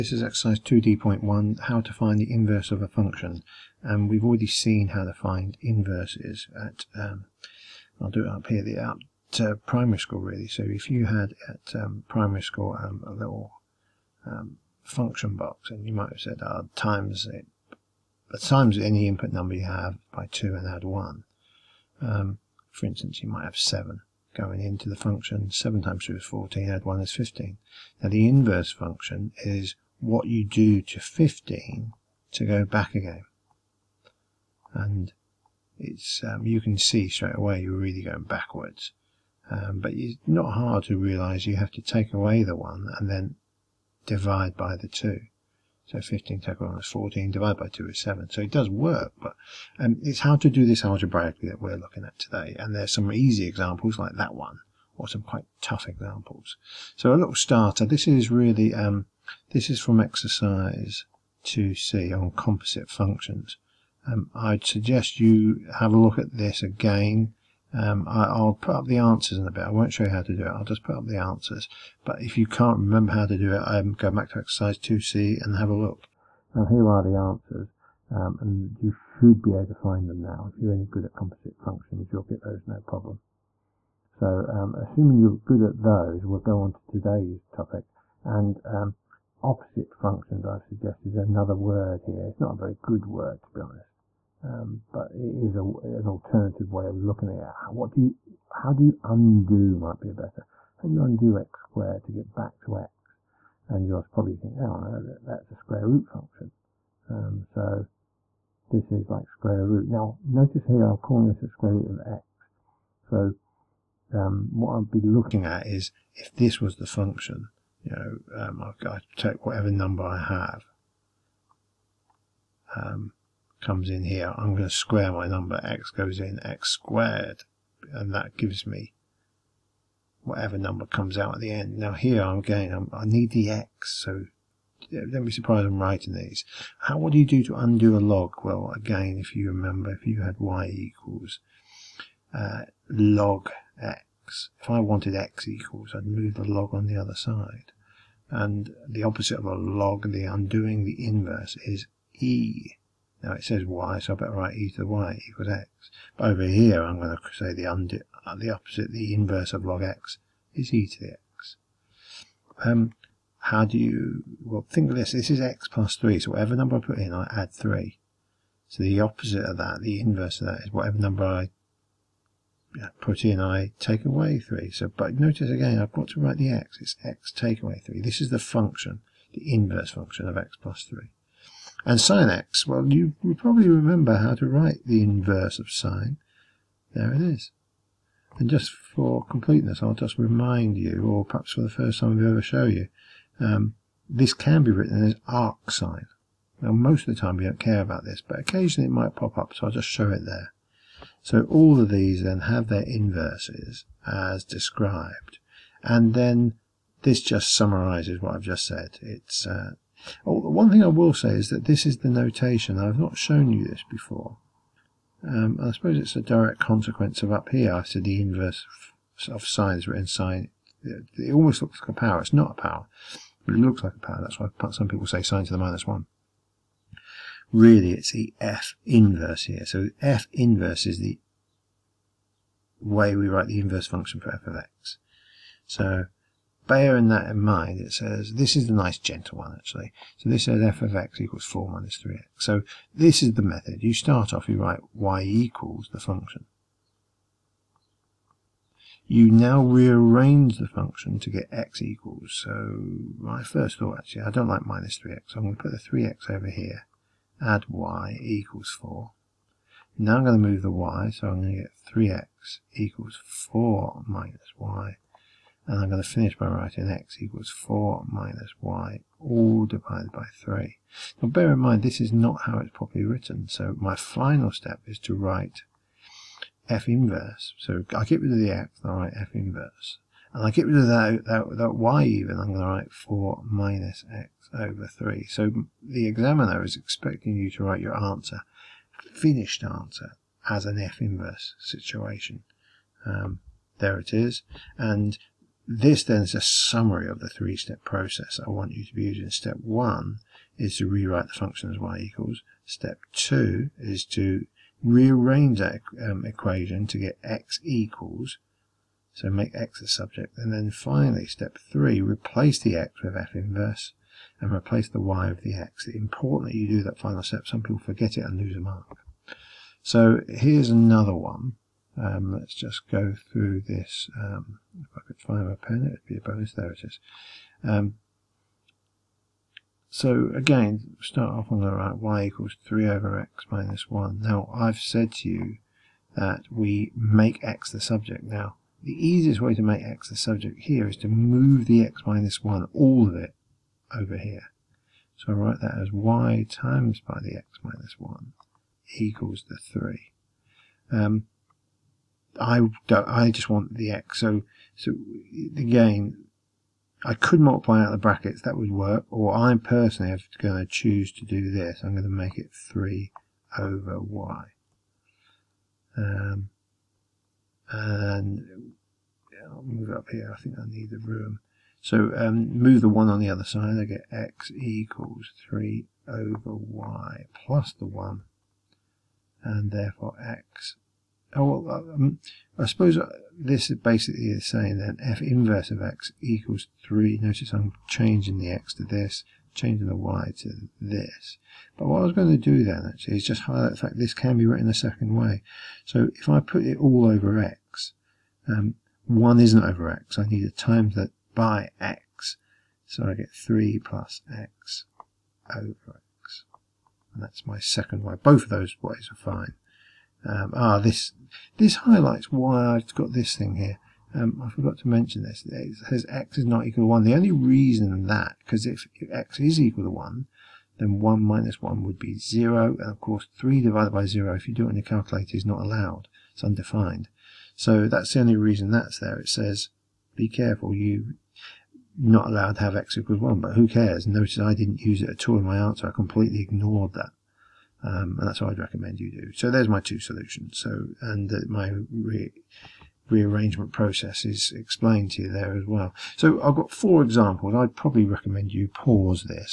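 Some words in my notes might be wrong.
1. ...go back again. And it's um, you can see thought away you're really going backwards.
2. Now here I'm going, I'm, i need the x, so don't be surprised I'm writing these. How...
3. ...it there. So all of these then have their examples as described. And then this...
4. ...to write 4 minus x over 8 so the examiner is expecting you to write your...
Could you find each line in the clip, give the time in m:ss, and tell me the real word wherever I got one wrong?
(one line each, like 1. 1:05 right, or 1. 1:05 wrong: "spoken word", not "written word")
1. 0:32 wrong: "straight", not "thought"
2. 2:11 right
3. 3:20 wrong: "inverses", not "examples"
4. 4:42 wrong: "3", not "8".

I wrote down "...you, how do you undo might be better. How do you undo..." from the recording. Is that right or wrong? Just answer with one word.
right.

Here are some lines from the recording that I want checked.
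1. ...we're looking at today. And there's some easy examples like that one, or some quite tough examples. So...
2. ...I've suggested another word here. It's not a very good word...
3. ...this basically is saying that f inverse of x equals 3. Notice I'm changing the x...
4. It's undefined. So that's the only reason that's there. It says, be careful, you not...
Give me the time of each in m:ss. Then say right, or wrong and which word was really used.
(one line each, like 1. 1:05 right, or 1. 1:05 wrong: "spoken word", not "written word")
1. 0:51 right
2. 1:30 right
3. 6:23 right
4. 7:06 right.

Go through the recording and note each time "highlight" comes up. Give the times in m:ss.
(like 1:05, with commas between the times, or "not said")
6:33, 6:51.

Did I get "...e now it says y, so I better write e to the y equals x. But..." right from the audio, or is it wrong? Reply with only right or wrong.
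right.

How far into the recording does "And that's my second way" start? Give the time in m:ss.
6:47.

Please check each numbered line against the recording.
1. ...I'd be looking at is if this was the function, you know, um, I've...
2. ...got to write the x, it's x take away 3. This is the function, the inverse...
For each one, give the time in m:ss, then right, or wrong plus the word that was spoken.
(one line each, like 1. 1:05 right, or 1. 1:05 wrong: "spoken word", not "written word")
1. 1:54 right
2. 2:55 right.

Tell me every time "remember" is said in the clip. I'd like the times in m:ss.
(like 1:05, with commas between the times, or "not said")
1:12, 2:19, 3:03.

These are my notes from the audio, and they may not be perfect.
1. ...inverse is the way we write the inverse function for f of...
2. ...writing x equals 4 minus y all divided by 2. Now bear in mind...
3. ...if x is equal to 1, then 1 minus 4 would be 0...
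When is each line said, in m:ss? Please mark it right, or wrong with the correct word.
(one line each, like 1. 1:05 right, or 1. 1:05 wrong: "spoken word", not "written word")
1. 3:50 right
2. 4:26 wrong: "3", not "2"
3. 6:58 wrong: "1", not "4".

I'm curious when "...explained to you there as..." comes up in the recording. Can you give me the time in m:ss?
7:24.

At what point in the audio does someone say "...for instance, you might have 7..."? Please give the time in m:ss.
0:22.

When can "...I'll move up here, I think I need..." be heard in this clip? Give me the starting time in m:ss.
6:09.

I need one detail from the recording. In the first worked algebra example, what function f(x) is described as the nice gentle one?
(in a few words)
4 minus 3x.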